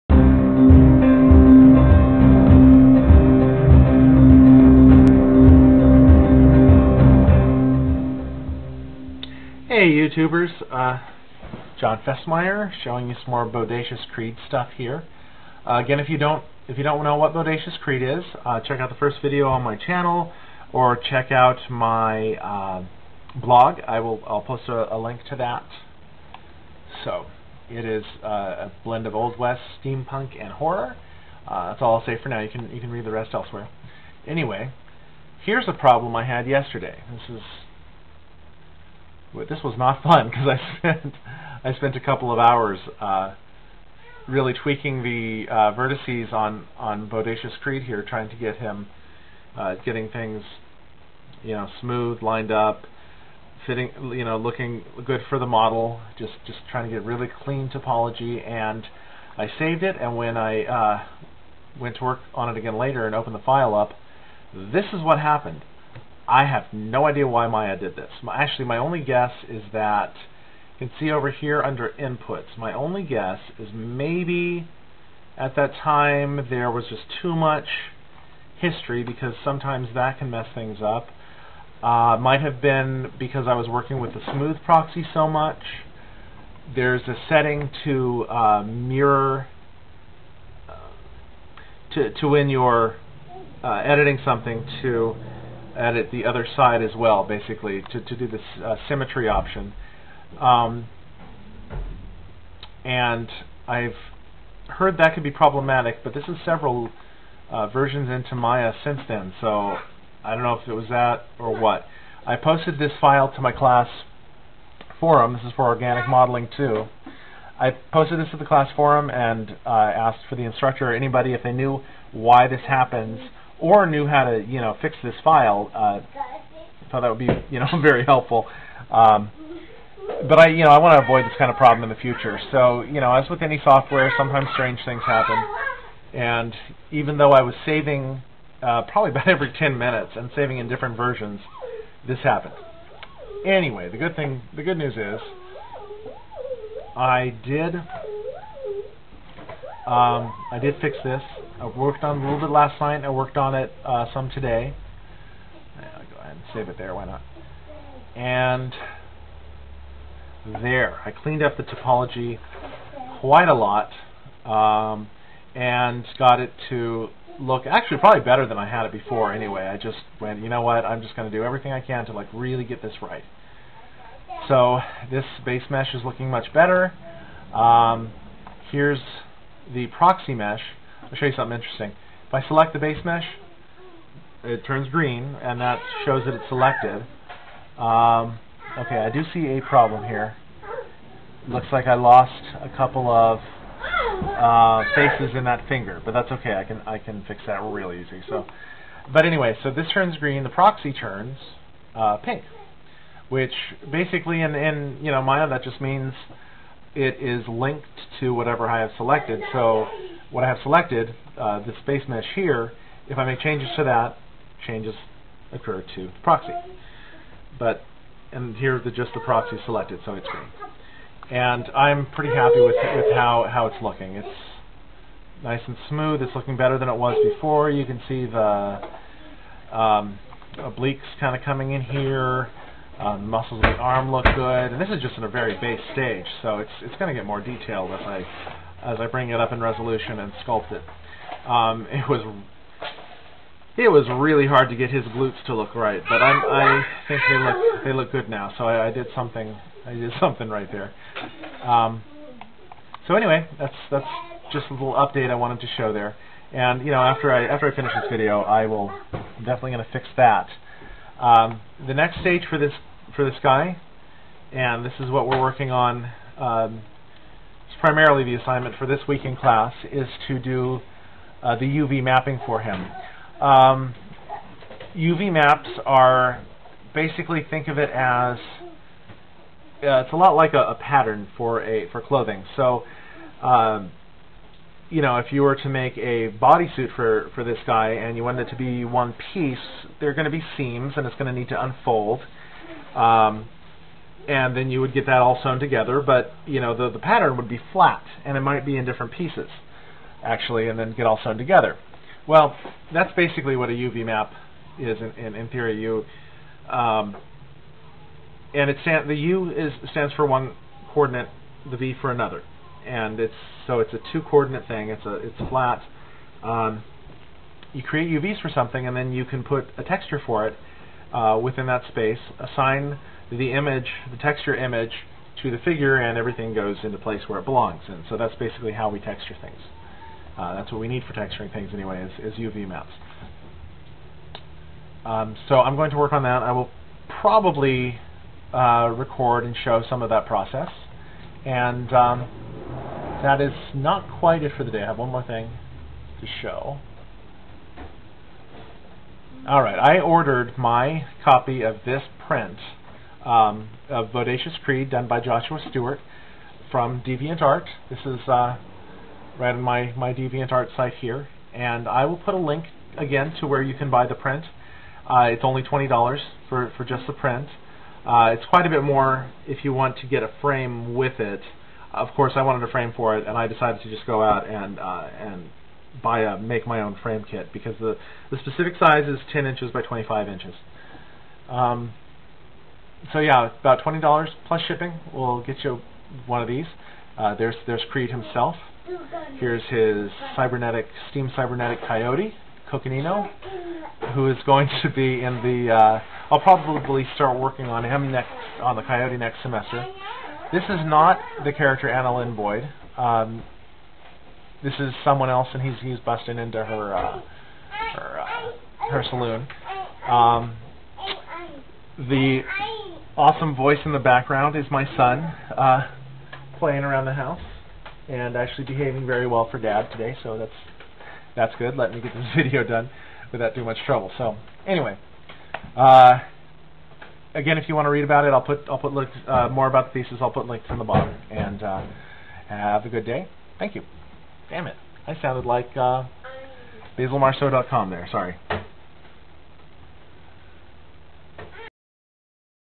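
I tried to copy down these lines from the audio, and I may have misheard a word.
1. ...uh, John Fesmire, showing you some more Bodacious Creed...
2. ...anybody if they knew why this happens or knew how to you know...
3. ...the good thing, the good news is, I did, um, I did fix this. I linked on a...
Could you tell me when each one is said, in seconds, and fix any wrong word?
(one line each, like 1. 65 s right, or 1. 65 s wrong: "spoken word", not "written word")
1. 10 s right
2. 120 s right
3. 143 s wrong: "worked", not "linked".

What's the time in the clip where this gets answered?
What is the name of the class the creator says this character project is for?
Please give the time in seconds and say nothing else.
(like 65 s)
115 s.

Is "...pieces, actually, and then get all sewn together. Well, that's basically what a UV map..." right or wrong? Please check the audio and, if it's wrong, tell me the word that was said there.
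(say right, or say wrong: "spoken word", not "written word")
right.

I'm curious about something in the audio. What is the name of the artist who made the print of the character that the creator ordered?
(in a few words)
Joshua Stewart.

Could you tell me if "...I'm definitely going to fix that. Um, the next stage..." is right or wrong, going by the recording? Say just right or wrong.
right.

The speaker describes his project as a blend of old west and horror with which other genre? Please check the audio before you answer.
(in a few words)
steampunk.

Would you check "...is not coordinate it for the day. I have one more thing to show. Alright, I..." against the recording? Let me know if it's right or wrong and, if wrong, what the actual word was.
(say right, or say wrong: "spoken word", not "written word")
wrong: "quite", not "coordinate".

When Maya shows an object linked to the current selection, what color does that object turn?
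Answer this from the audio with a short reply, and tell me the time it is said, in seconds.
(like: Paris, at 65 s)
pink, at 202 s.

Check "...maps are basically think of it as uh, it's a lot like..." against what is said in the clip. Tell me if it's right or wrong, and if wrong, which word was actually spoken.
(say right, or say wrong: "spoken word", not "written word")
right.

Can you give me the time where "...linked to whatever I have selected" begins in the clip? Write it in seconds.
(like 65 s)
207 s.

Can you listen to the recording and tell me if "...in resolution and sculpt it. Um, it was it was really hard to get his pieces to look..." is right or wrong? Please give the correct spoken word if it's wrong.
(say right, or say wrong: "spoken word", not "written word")
wrong: "glutes", not "pieces".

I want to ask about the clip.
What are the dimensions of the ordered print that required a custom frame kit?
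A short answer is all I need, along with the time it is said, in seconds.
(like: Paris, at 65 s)
10 inches by 25 inches, at 379 s.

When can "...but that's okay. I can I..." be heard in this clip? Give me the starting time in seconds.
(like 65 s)
196 s.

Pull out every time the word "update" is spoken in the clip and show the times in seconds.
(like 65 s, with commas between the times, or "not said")
254 s.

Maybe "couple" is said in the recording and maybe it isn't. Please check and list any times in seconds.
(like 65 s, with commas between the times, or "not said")
41 s, 192 s.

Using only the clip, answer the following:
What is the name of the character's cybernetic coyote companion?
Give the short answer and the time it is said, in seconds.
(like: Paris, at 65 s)
Coconino, at 392 s.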